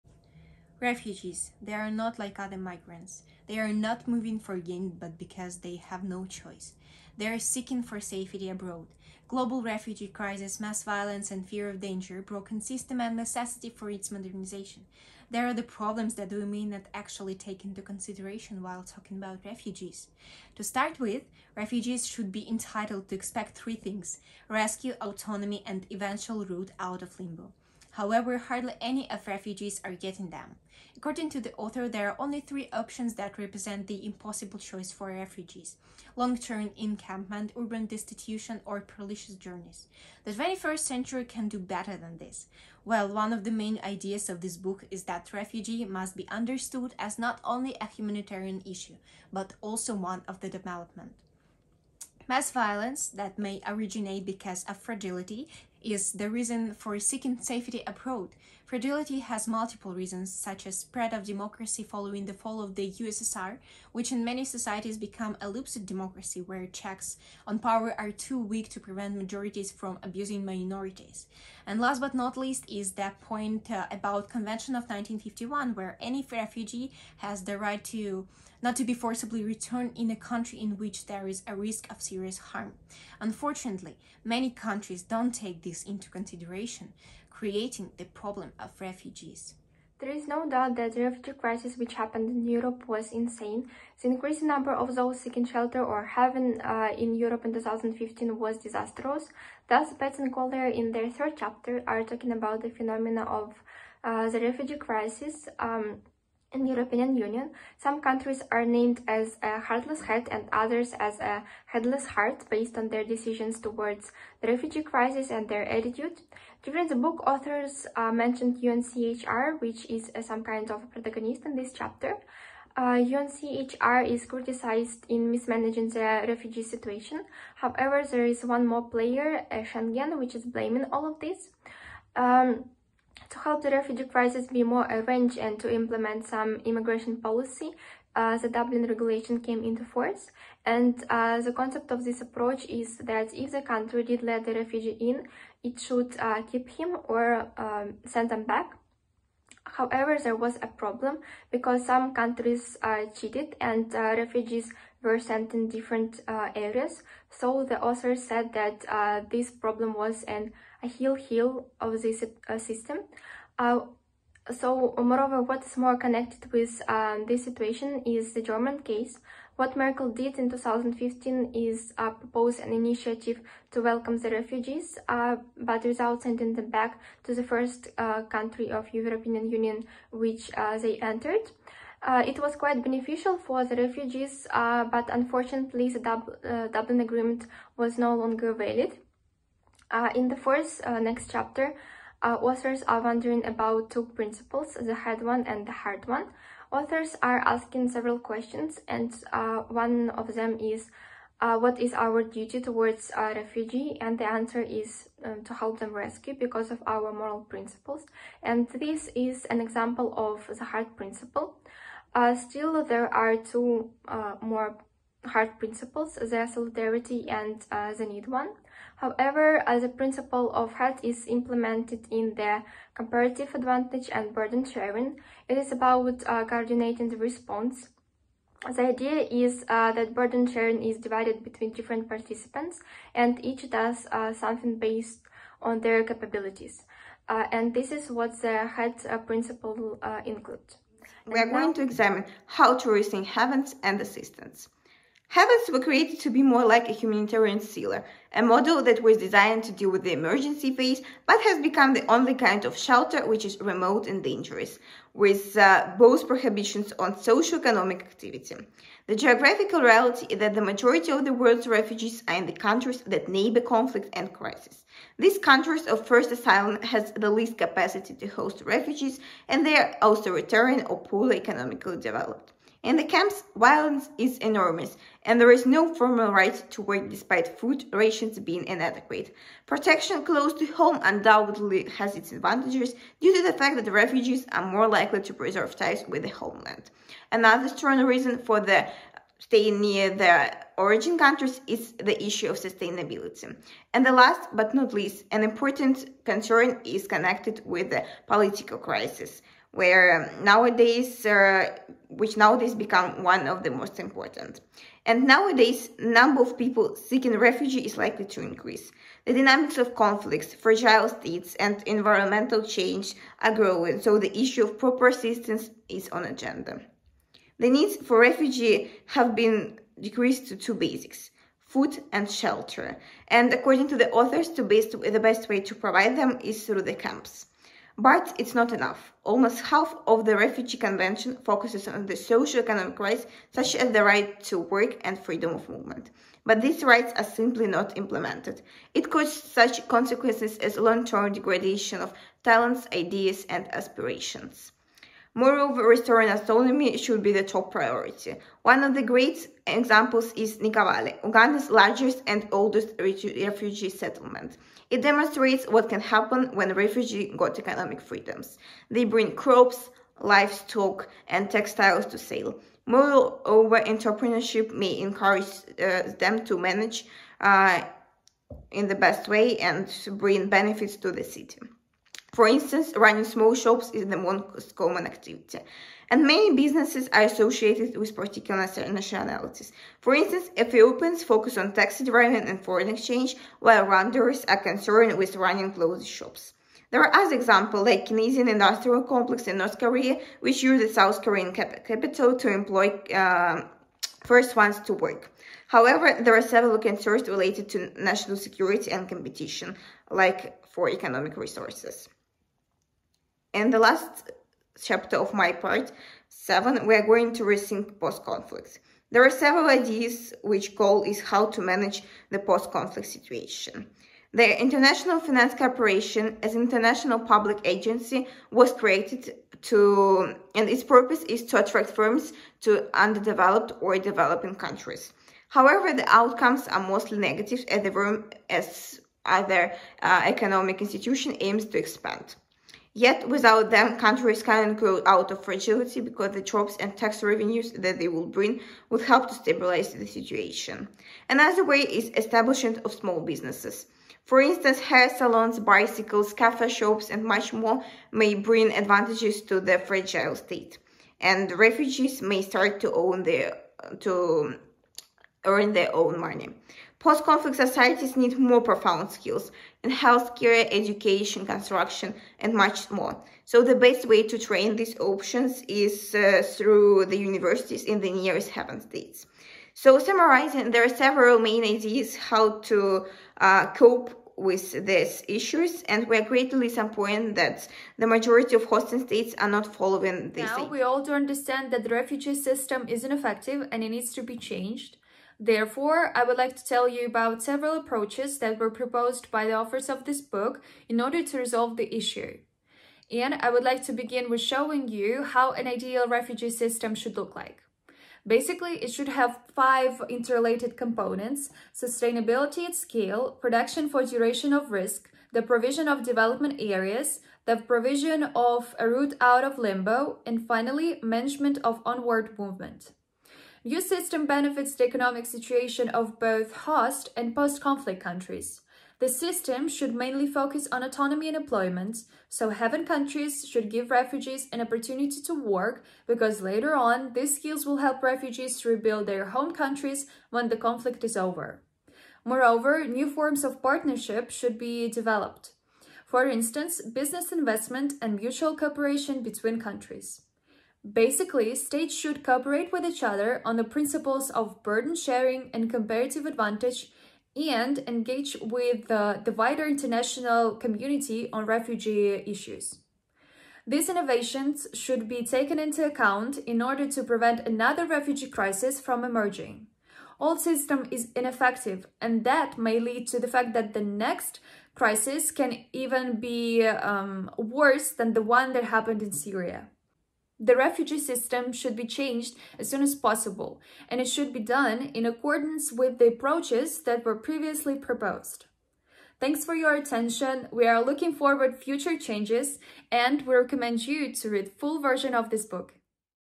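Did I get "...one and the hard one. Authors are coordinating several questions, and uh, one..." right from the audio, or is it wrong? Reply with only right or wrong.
wrong.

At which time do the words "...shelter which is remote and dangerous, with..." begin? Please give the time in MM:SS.
04:12.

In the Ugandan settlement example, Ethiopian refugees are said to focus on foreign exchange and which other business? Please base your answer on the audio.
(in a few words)
Taxi driving.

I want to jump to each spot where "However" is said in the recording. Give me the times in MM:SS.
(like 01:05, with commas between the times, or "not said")
00:27, 02:07, 02:29, 03:39, 06:35, 07:05.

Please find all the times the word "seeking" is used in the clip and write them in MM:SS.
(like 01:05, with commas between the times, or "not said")
00:07, 00:56, 01:35, 05:06.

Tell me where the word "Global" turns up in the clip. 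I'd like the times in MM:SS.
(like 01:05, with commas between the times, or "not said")
00:09.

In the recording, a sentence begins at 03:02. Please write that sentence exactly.
Uh, it was quite beneficial for the refugees, uh, but unfortunately the Dub Dublin Agreement was no longer valid.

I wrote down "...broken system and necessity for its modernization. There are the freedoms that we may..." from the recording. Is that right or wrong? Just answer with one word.
wrong.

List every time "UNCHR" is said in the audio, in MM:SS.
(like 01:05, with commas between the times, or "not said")
01:58, 02:03.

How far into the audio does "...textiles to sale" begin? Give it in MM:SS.
06:01.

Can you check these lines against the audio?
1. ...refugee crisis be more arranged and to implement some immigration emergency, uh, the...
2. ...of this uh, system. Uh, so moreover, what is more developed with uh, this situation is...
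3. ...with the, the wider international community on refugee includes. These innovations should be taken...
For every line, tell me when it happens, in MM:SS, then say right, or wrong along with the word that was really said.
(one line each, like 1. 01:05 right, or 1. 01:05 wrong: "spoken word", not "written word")
1. 02:13 wrong: "policy", not "emergency"
2. 02:41 wrong: "connected", not "developed"
3. 09:08 wrong: "issues", not "includes".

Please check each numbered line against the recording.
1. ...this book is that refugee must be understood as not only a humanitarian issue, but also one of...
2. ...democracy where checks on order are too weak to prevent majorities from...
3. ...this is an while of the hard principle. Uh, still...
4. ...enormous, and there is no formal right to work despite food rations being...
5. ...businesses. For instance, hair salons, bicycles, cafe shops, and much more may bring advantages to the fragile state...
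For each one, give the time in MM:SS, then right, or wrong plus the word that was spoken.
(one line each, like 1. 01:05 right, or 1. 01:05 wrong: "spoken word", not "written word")
1. 00:44 right
2. 01:05 wrong: "power", not "order"
3. 03:28 wrong: "example", not "while"
4. 04:34 right
5. 07:23 right.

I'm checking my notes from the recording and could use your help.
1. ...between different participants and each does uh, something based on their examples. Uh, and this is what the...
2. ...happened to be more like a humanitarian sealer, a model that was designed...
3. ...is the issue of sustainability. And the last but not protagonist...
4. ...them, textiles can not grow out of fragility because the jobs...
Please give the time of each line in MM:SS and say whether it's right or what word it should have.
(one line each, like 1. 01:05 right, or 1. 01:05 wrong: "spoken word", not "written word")
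1. 03:51 wrong: "capabilities", not "examples"
2. 04:05 wrong: "created", not "happened"
3. 04:51 wrong: "least", not "protagonist"
4. 07:13 wrong: "countries", not "textiles".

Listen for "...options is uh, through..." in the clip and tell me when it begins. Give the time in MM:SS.
07:44.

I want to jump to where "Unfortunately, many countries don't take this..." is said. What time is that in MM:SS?
01:23.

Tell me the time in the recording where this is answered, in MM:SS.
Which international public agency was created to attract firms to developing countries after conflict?
06:54.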